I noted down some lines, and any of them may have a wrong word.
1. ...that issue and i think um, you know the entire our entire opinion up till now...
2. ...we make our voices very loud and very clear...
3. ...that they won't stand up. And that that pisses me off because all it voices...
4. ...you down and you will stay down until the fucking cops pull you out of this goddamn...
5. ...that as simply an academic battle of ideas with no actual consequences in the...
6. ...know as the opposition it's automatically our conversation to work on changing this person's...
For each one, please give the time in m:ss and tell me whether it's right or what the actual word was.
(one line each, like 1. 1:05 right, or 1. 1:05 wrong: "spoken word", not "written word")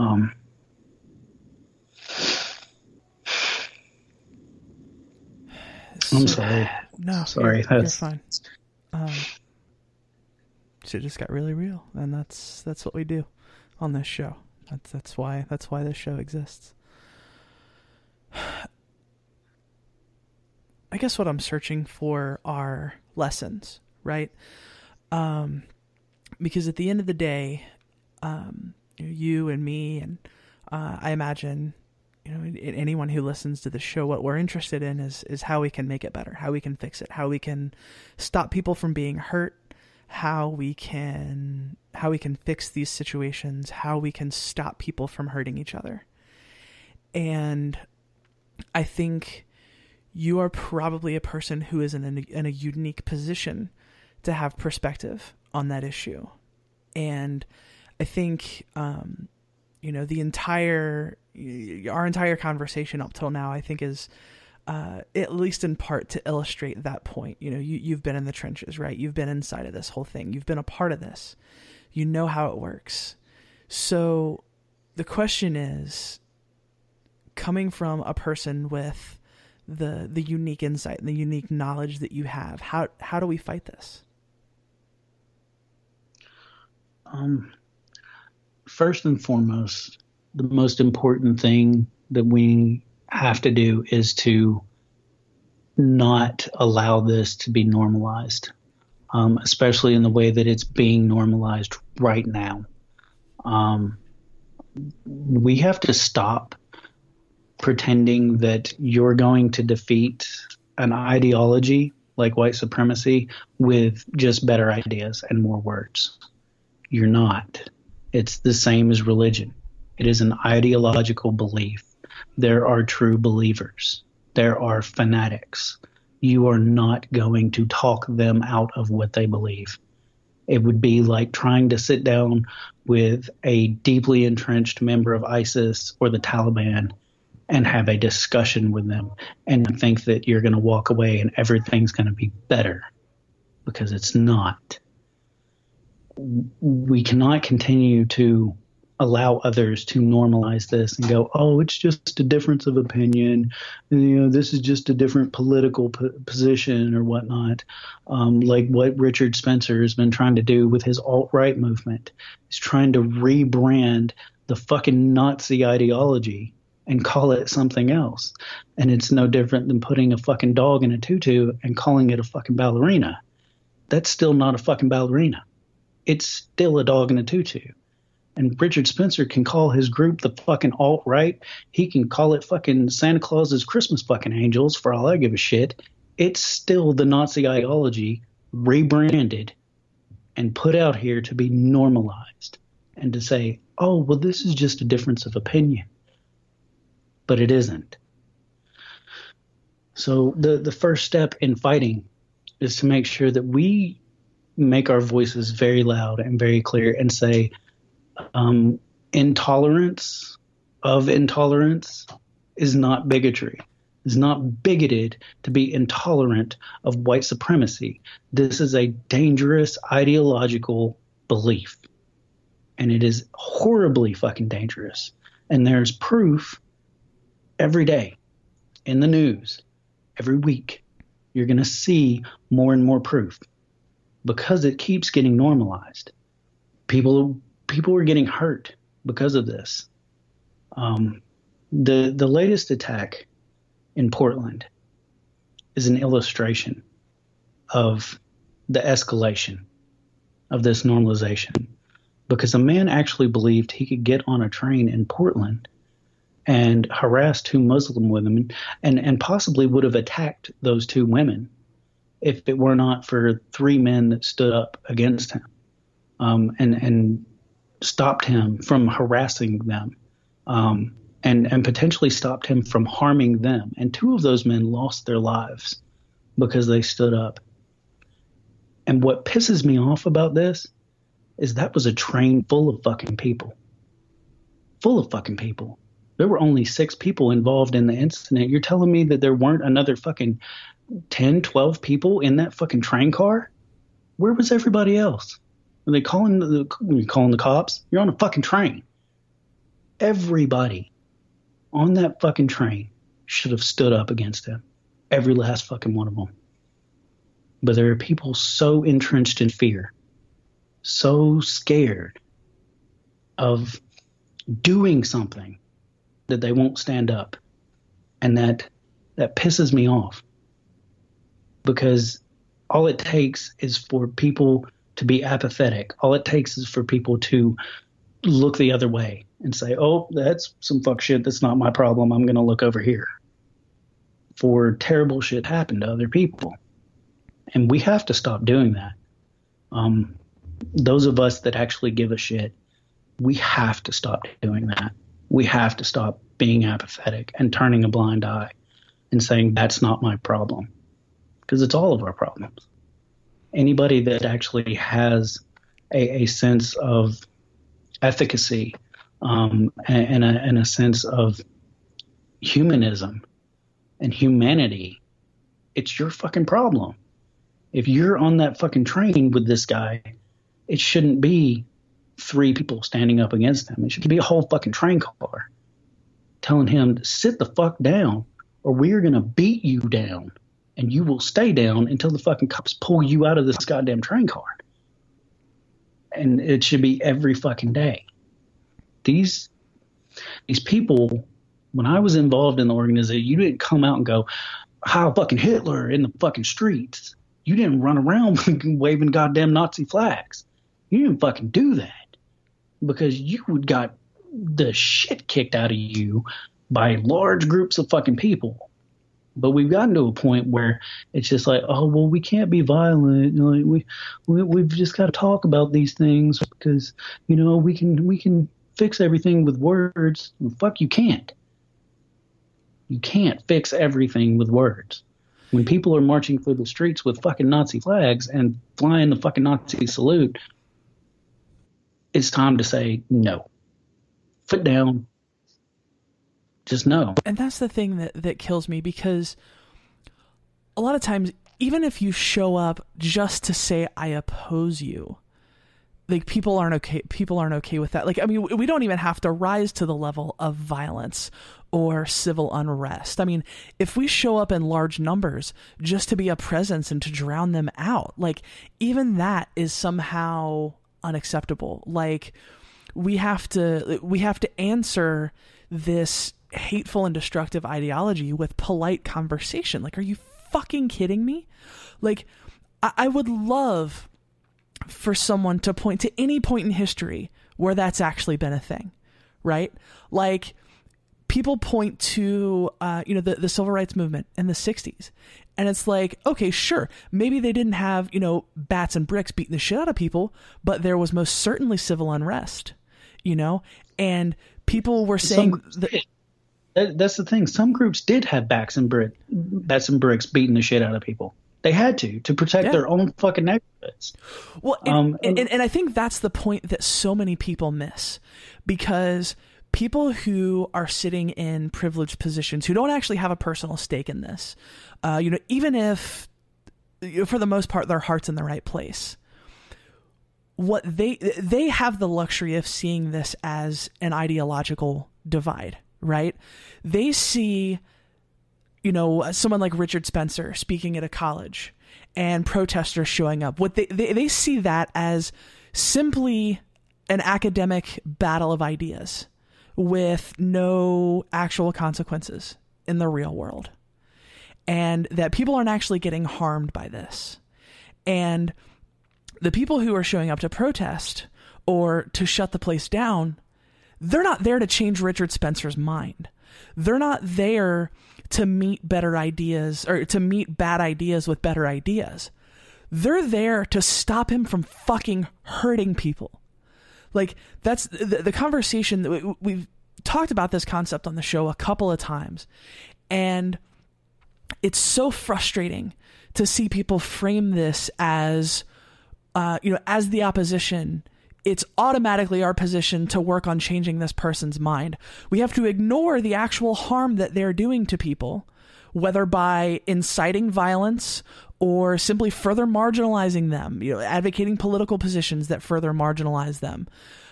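1. 0:55 wrong: "conversation", not "opinion"
2. 3:23 right
3. 5:16 wrong: "takes", not "voices"
4. 6:19 right
5. 8:54 right
6. 9:39 wrong: "position", not "conversation".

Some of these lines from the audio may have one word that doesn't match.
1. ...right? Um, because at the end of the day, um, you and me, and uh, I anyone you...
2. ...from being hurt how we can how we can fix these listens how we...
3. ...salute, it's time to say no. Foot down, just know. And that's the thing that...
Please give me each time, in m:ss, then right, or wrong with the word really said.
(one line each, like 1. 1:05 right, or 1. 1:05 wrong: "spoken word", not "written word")
1. 0:24 wrong: "imagine", not "anyone"
2. 0:38 wrong: "situations", not "listens"
3. 7:09 right.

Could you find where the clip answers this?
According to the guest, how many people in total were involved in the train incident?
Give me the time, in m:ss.
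4:46.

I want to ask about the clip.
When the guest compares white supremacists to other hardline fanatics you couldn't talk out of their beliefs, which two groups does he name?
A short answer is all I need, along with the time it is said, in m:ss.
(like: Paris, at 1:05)
ISIS or the Taliban, at 2:15.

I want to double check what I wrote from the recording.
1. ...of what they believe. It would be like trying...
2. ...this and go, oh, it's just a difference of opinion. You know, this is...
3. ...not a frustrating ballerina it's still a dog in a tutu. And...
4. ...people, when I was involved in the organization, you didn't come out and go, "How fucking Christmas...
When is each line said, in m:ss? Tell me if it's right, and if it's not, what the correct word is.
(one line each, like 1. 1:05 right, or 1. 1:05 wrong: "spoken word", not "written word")
1. 2:08 right
2. 2:30 right
3. 2:54 wrong: "fucking", not "frustrating"
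4. 6:30 wrong: "Hitler", not "Christmas".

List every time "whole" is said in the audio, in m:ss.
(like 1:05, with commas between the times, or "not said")
1:09, 6:14.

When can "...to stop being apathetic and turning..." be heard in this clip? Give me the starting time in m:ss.
5:45.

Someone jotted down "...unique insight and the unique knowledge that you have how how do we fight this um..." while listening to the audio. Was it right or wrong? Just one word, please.
right.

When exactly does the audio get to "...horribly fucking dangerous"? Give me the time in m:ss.
3:43.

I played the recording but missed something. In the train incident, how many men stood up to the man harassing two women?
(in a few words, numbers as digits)
3.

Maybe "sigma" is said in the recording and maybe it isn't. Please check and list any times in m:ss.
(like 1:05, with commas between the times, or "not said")
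not said.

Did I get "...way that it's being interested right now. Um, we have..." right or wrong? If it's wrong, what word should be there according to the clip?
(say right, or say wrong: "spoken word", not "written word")
wrong: "normalized", not "interested".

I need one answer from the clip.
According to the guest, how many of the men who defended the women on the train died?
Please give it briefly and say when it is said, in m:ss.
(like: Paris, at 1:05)
2, at 4:33.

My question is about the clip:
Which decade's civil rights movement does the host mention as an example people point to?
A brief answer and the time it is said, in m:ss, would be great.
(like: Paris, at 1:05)
the 60s, at 8:04.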